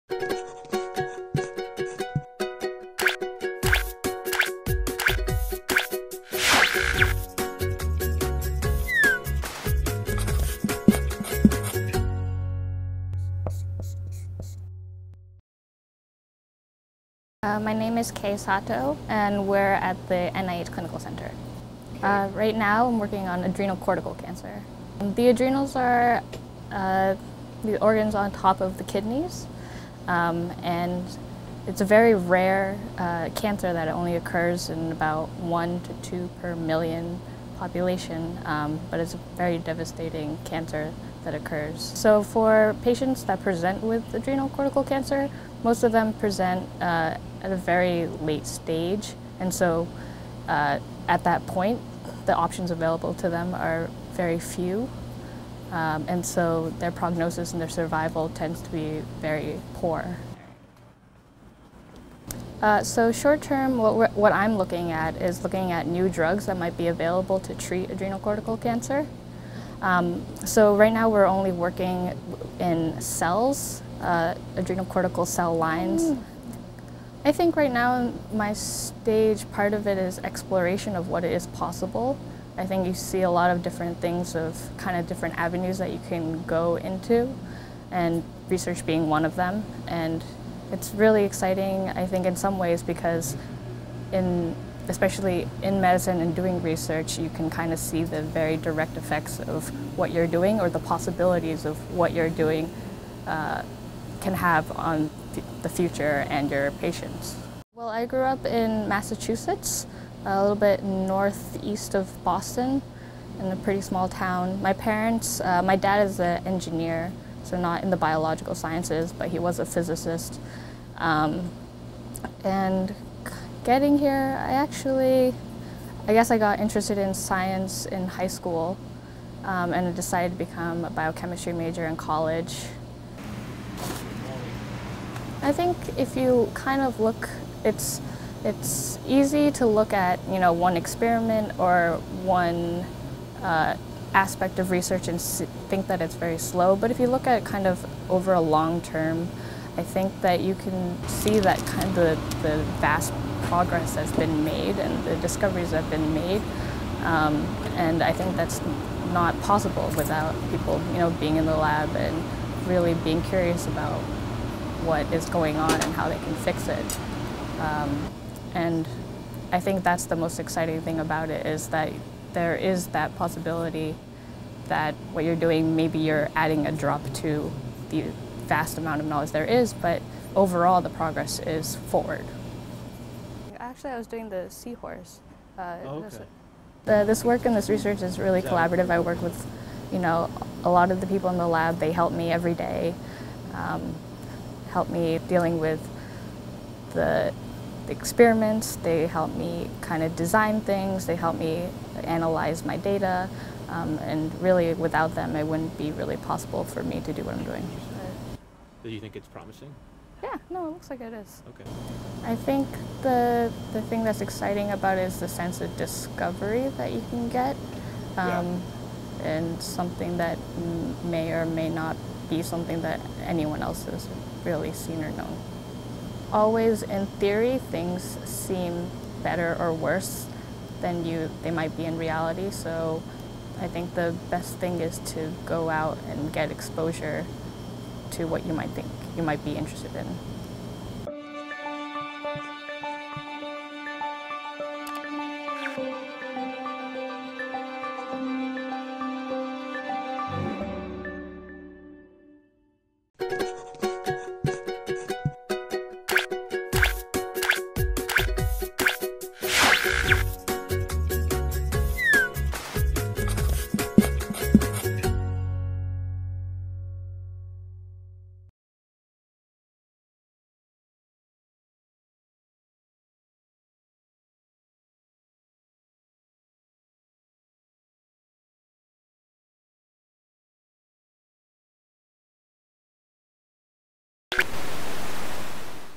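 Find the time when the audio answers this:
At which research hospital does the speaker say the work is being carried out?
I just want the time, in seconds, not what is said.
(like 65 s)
20 s.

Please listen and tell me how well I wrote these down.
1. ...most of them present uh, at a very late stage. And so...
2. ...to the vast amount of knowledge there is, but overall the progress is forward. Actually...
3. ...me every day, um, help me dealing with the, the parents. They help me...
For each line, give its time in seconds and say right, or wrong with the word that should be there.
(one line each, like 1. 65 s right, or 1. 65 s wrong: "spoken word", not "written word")
1. 45 s right
2. 177 s right
3. 192 s wrong: "experiments", not "parents".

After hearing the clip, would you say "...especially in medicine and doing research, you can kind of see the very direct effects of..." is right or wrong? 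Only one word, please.
right.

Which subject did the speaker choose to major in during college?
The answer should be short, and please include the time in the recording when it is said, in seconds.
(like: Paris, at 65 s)
Biochemistry, at 130 s.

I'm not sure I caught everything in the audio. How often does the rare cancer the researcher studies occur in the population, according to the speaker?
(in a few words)
1 to 2 per million.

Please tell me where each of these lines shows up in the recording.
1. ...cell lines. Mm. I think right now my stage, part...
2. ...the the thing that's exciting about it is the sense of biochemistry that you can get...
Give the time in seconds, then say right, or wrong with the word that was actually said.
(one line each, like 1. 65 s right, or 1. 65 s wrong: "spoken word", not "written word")
1. 75 s right
2. 213 s wrong: "discovery", not "biochemistry".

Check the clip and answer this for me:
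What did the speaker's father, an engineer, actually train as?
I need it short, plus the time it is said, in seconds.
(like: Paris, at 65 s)
Physicist, at 119 s.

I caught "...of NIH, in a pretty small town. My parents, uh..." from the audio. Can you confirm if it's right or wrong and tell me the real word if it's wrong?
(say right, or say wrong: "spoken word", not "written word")
wrong: "Boston", not "NIH".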